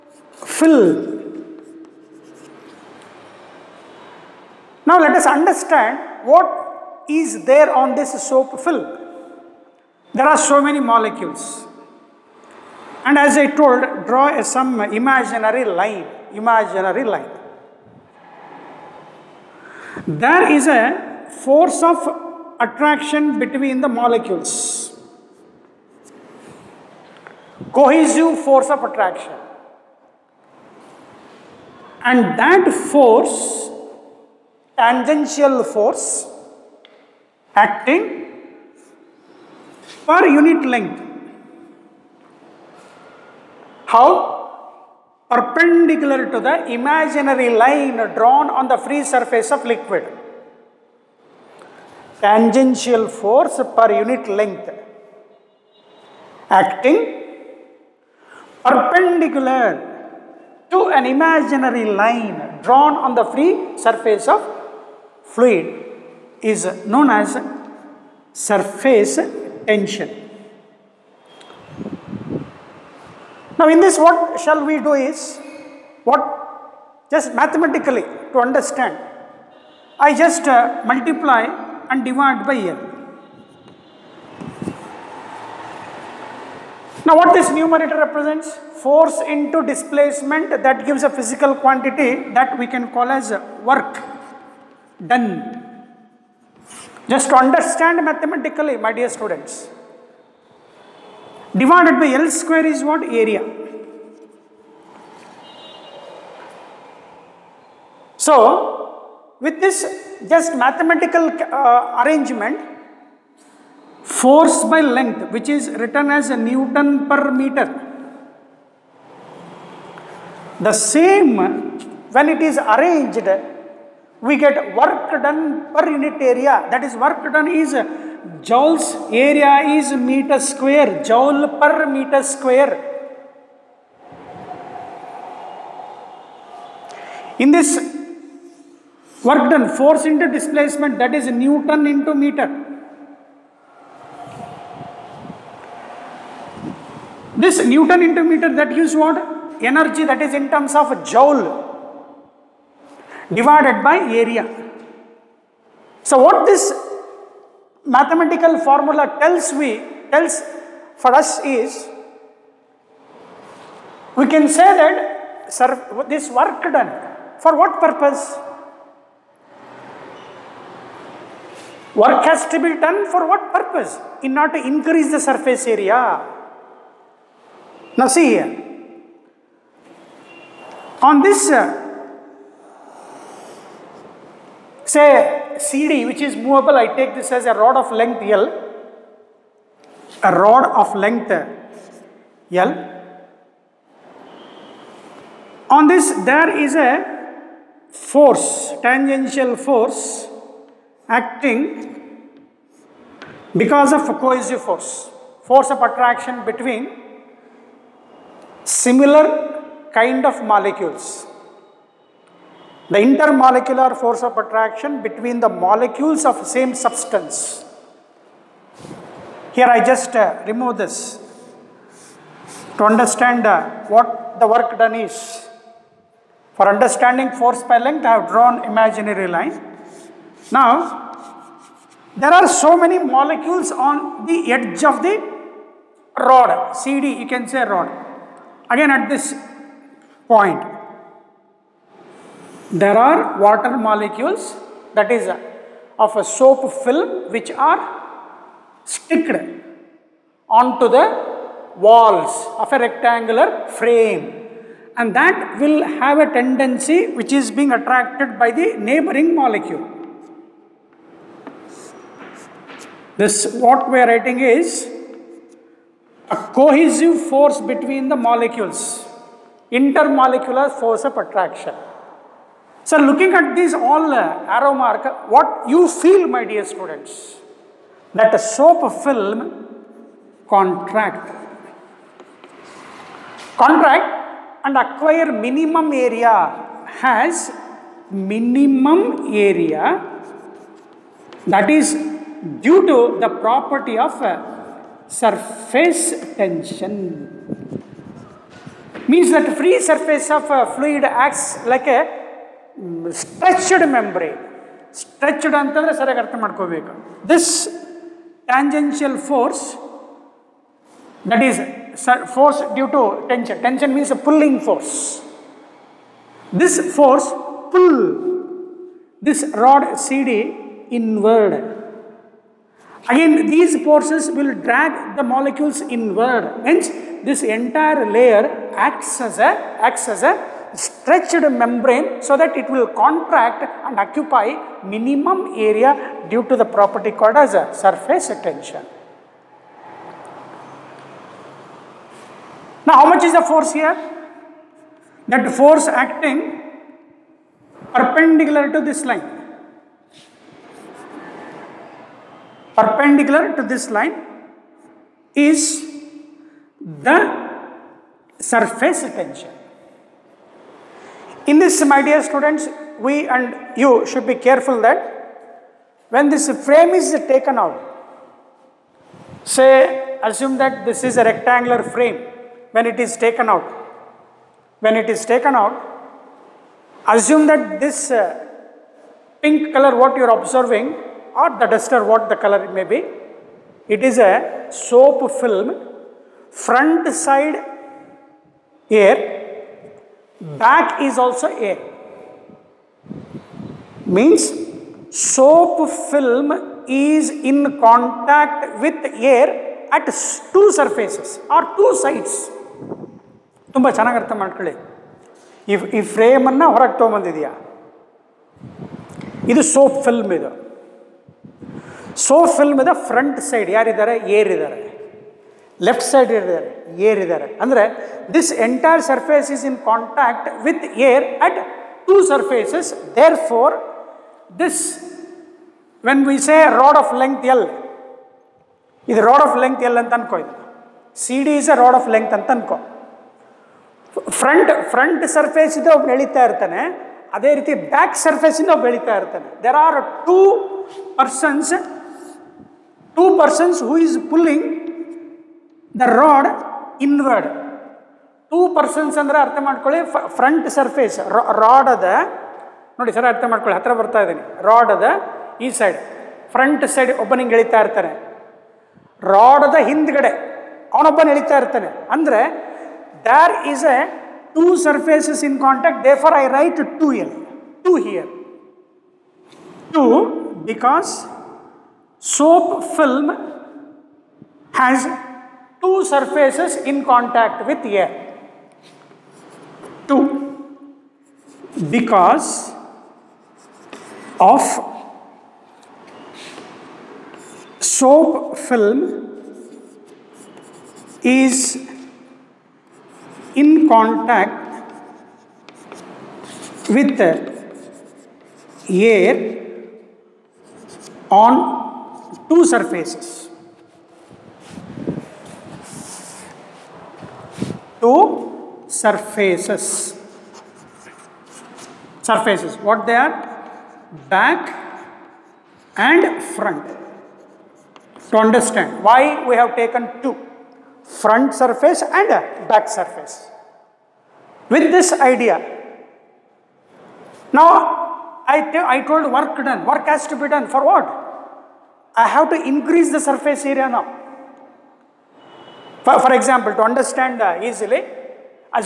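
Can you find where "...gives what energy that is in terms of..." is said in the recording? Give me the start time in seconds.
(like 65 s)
148 s.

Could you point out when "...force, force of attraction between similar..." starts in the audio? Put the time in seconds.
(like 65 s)
204 s.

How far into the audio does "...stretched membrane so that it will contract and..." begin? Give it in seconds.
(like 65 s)
330 s.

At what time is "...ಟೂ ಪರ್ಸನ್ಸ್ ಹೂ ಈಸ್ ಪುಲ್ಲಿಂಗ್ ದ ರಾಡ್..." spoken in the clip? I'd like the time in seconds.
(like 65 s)
443 s.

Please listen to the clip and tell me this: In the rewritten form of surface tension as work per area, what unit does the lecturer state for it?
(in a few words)
joule per meter square.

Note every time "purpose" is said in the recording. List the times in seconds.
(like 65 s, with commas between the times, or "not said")
167 s, 173 s.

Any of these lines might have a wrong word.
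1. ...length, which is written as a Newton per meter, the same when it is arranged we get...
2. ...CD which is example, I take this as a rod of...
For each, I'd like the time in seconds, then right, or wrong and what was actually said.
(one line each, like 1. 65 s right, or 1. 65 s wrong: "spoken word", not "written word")
1. 114 s right
2. 185 s wrong: "movable", not "example".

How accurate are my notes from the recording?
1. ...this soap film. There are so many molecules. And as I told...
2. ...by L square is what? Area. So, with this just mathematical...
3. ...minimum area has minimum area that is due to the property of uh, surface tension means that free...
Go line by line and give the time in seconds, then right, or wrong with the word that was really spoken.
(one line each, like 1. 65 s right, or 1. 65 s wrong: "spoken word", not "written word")
1. 7 s right
2. 101 s right
3. 285 s right.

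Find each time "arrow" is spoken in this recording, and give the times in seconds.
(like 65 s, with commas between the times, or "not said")
274 s.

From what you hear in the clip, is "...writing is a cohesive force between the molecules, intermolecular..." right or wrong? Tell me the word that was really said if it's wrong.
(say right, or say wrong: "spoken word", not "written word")
right.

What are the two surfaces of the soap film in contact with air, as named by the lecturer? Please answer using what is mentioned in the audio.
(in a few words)
Back and front.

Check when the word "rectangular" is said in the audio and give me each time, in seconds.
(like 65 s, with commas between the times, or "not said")
252 s, 371 s.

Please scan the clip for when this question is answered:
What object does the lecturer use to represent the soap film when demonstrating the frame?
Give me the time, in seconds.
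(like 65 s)
381 s.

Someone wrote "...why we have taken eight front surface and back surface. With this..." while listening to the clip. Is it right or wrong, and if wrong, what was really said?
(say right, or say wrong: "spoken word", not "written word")
wrong: "two", not "eight".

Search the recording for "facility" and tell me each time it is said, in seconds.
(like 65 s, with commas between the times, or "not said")
not said.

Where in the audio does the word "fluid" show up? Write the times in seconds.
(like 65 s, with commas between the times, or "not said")
65 s, 300 s.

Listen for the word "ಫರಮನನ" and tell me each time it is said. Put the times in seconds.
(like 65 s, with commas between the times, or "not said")
406 s.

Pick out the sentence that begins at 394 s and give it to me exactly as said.
Means soap film is in contact with air at two surfaces or two sides.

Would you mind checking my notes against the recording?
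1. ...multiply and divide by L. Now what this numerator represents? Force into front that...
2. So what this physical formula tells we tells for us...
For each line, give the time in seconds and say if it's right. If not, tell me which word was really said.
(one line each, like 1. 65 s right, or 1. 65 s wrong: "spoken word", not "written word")
1. 80 s wrong: "displacement", not "front"
2. 156 s wrong: "mathematical", not "physical".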